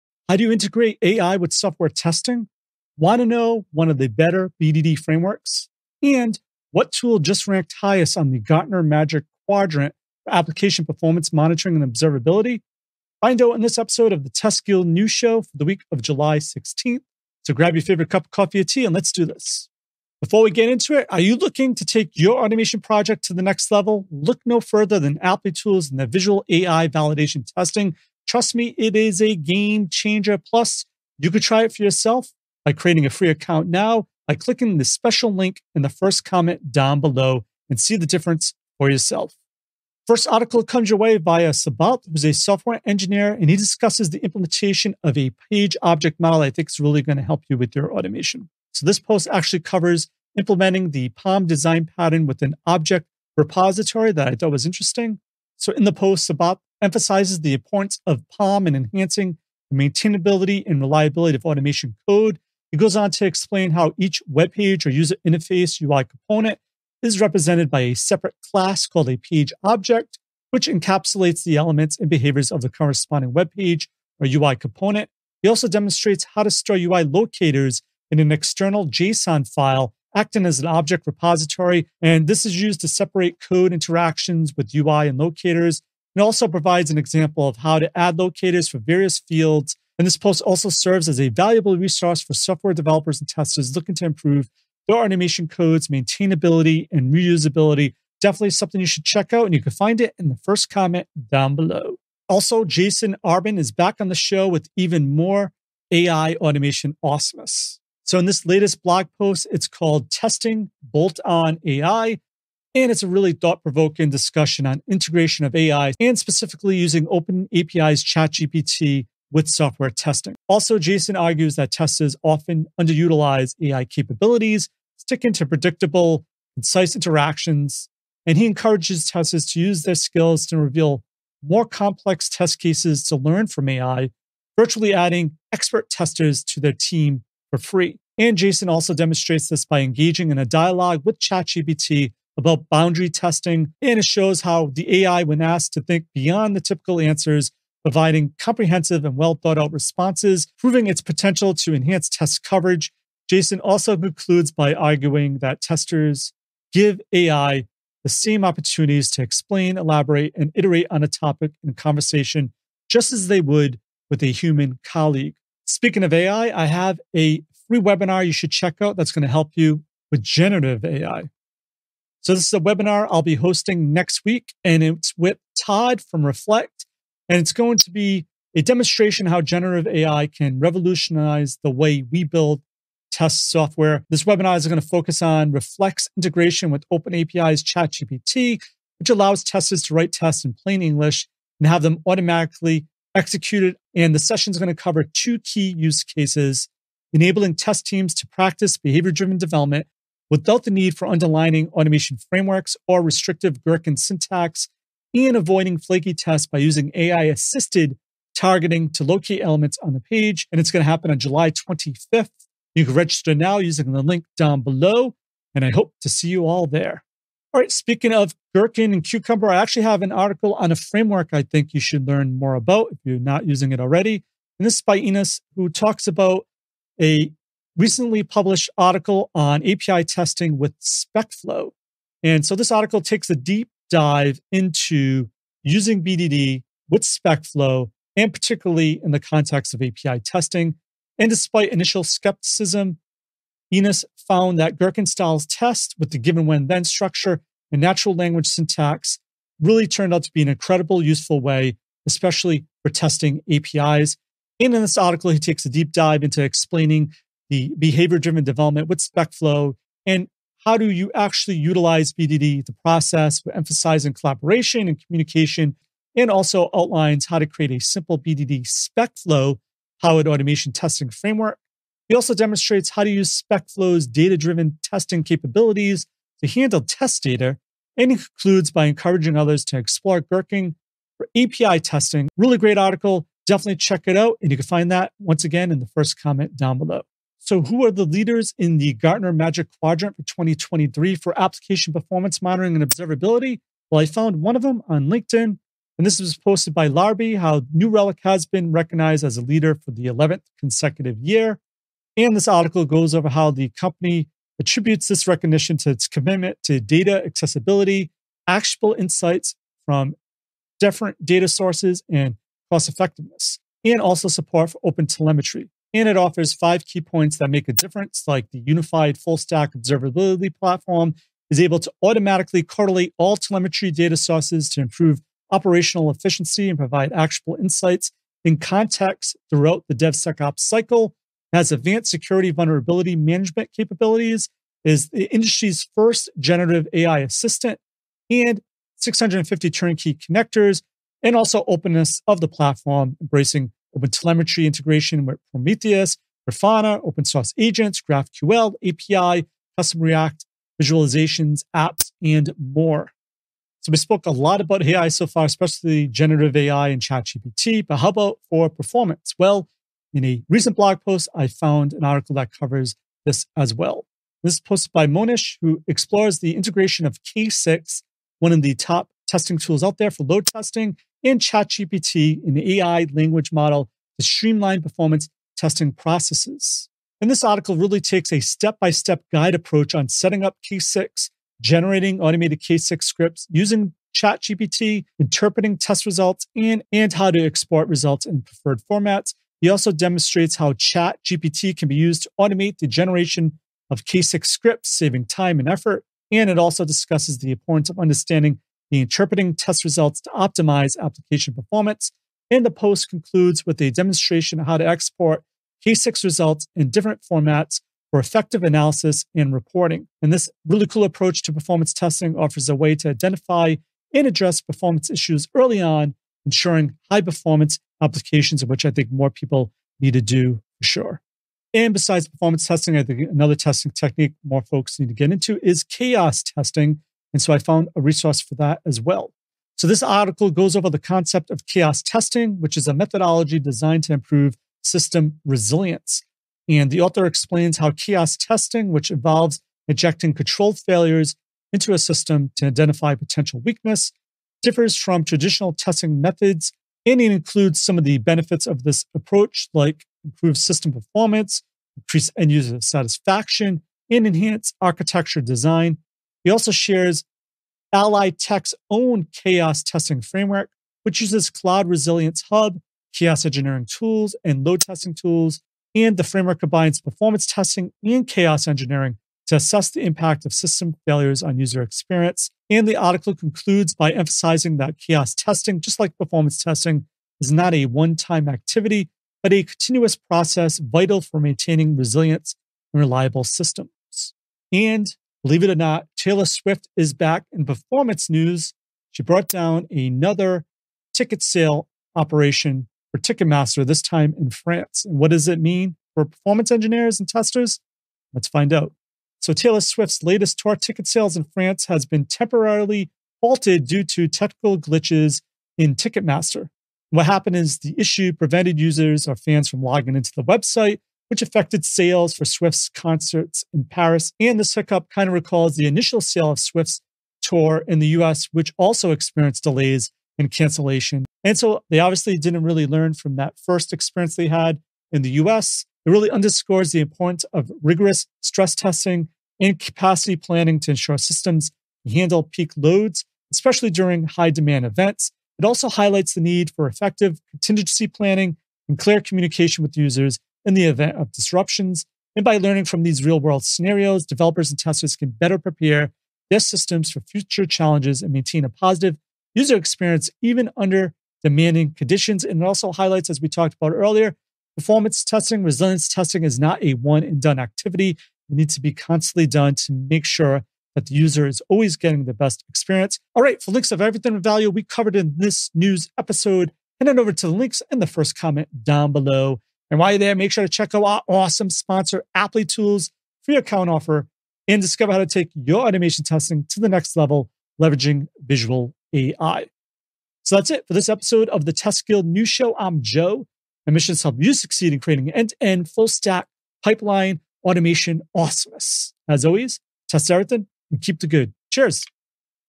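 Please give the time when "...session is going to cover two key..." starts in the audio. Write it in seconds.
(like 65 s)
194 s.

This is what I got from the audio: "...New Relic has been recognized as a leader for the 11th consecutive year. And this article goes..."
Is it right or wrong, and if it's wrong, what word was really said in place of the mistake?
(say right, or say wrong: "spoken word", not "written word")
right.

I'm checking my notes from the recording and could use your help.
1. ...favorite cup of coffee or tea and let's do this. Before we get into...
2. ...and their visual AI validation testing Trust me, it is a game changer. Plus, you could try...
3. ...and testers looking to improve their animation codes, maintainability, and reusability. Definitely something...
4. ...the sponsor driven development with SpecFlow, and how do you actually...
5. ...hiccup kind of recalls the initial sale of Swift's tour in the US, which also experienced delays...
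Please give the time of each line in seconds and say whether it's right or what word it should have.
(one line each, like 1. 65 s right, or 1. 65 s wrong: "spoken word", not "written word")
1. 17 s right
2. 25 s right
3. 93 s right
4. 257 s wrong: "behavior", not "sponsor"
5. 514 s right.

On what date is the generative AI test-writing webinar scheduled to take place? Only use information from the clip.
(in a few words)
July 25th.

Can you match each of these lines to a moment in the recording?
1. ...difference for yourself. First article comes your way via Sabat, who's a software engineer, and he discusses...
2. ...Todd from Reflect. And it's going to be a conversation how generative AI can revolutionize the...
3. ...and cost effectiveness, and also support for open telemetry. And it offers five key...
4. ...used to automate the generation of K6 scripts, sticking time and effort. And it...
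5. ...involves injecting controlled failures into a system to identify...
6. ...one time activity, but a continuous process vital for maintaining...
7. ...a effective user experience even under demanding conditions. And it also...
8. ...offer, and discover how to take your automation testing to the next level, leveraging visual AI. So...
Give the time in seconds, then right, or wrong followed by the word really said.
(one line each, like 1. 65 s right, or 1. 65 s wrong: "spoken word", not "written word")
1. 38 s right
2. 175 s wrong: "demonstration", not "conversation"
3. 312 s right
4. 391 s wrong: "saving", not "sticking"
5. 439 s right
6. 477 s right
7. 548 s wrong: "positive", not "effective"
8. 573 s right.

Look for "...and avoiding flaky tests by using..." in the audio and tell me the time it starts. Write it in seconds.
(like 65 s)
205 s.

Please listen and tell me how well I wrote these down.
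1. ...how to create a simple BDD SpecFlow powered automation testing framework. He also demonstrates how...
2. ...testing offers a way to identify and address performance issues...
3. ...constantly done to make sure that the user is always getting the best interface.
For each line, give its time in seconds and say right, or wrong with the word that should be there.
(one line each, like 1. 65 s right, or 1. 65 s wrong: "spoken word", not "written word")
1. 267 s right
2. 411 s right
3. 558 s wrong: "experience", not "interface".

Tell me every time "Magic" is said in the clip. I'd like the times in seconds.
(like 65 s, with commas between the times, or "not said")
8 s, 289 s.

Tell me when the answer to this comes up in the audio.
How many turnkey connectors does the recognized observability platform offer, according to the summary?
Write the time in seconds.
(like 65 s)
338 s.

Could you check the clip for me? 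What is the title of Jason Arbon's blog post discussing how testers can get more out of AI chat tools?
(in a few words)
Testing Bolt On AI.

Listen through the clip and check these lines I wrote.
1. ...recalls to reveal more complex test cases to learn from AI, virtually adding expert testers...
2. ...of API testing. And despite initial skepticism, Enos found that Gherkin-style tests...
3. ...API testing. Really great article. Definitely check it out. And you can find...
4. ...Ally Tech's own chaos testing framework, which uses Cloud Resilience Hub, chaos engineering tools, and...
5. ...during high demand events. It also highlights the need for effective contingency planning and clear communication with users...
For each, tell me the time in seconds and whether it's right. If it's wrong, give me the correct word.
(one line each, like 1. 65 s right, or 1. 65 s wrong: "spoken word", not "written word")
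1. 129 s wrong: "skills", not "recalls"
2. 239 s right
3. 281 s right
4. 457 s right
5. 533 s right.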